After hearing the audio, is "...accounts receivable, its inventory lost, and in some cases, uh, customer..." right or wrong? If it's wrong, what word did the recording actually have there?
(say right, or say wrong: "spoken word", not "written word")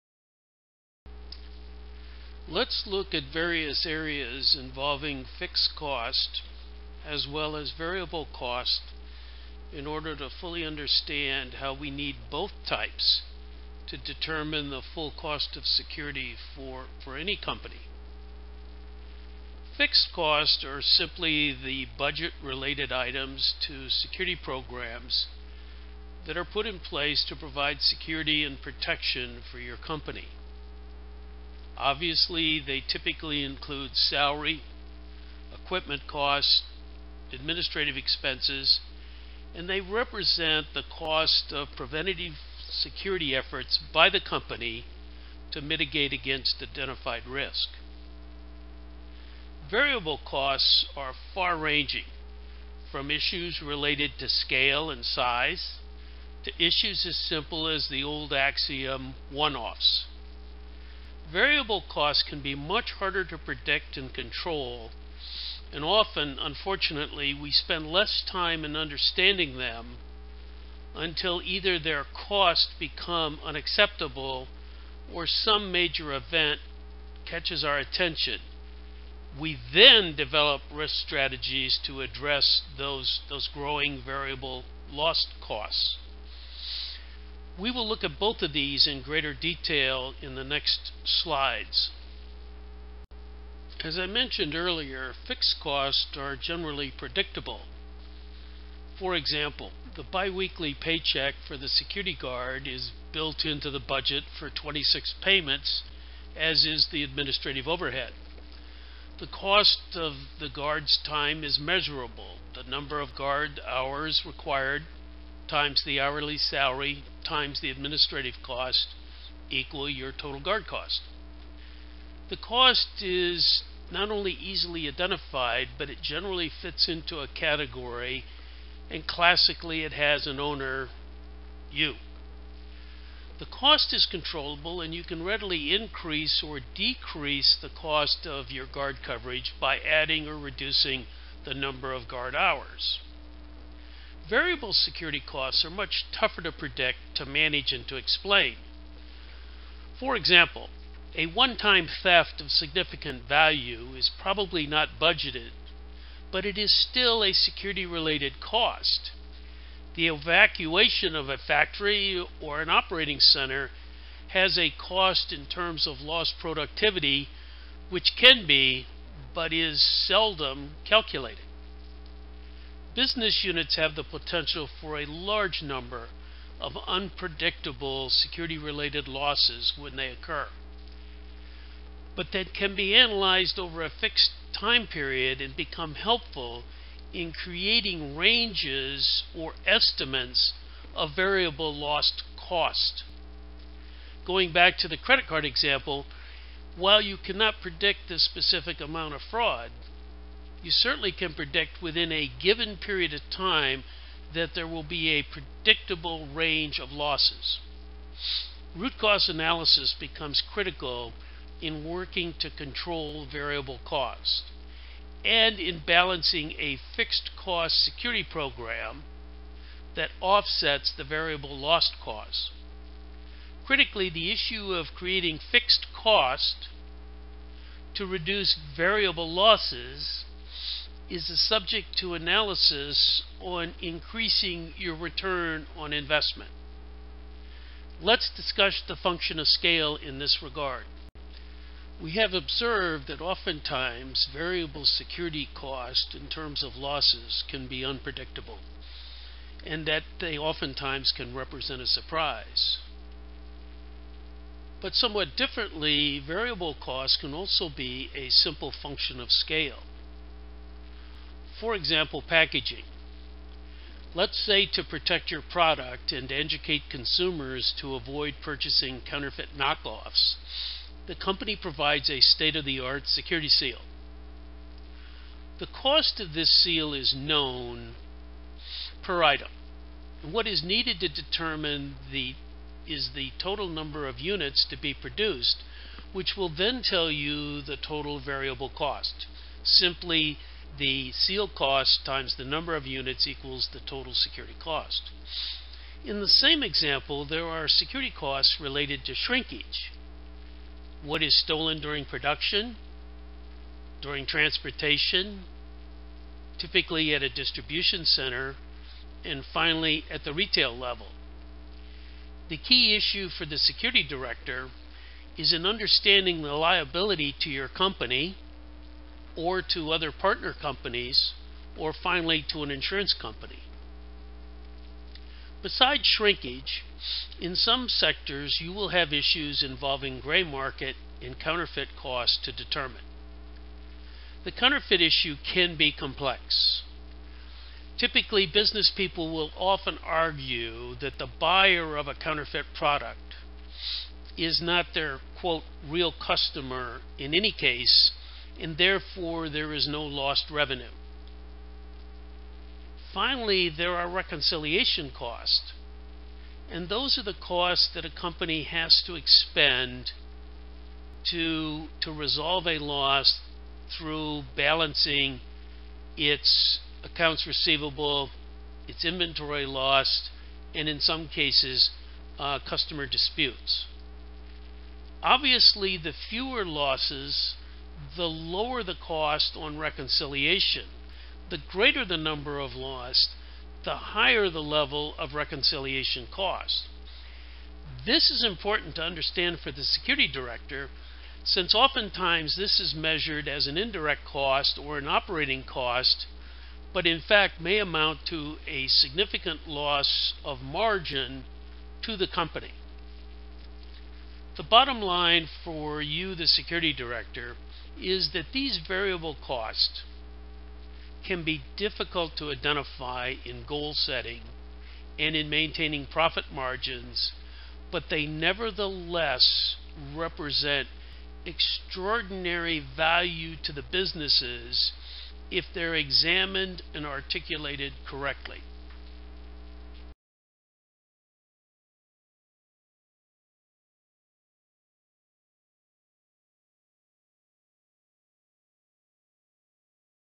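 right.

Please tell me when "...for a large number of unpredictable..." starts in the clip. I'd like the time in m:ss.
2:54.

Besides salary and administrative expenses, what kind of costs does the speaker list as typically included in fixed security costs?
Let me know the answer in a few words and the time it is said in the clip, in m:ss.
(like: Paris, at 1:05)
Equipment costs, at 0:35.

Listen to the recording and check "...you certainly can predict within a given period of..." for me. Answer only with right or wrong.
right.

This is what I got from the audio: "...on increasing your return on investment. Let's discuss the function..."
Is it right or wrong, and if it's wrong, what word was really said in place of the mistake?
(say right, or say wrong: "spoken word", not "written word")
right.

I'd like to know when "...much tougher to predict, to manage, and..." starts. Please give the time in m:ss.
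2:25.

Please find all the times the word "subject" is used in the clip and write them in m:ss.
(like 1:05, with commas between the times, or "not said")
3:51.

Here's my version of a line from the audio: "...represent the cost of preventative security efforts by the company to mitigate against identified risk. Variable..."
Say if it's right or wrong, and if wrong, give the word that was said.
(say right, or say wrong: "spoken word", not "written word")
right.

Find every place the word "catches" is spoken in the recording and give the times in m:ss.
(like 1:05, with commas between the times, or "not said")
1:17.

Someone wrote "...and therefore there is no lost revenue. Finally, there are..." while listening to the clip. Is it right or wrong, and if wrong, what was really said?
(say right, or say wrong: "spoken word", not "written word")
right.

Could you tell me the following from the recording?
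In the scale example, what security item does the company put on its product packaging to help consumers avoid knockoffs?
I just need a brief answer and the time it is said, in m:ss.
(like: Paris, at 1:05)
Security seal, at 4:33.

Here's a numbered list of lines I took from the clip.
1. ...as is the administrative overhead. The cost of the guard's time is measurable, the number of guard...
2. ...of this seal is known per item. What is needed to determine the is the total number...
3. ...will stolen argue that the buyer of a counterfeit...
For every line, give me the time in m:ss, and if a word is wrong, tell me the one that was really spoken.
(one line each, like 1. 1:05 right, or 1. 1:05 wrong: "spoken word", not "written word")
1. 1:46 right
2. 4:36 right
3. 5:39 wrong: "often", not "stolen".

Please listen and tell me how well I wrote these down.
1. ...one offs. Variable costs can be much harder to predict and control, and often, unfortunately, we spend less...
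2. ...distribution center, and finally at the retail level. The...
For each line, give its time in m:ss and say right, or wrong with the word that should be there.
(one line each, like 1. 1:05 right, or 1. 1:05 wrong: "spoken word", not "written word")
1. 0:59 right
2. 5:07 right.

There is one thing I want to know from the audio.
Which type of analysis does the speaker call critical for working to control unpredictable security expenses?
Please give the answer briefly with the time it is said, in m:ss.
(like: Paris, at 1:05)
Root cause analysis, at 3:28.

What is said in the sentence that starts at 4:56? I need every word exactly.
In the same example, there are security costs related to shrinkage.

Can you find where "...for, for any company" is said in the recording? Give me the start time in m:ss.
0:16.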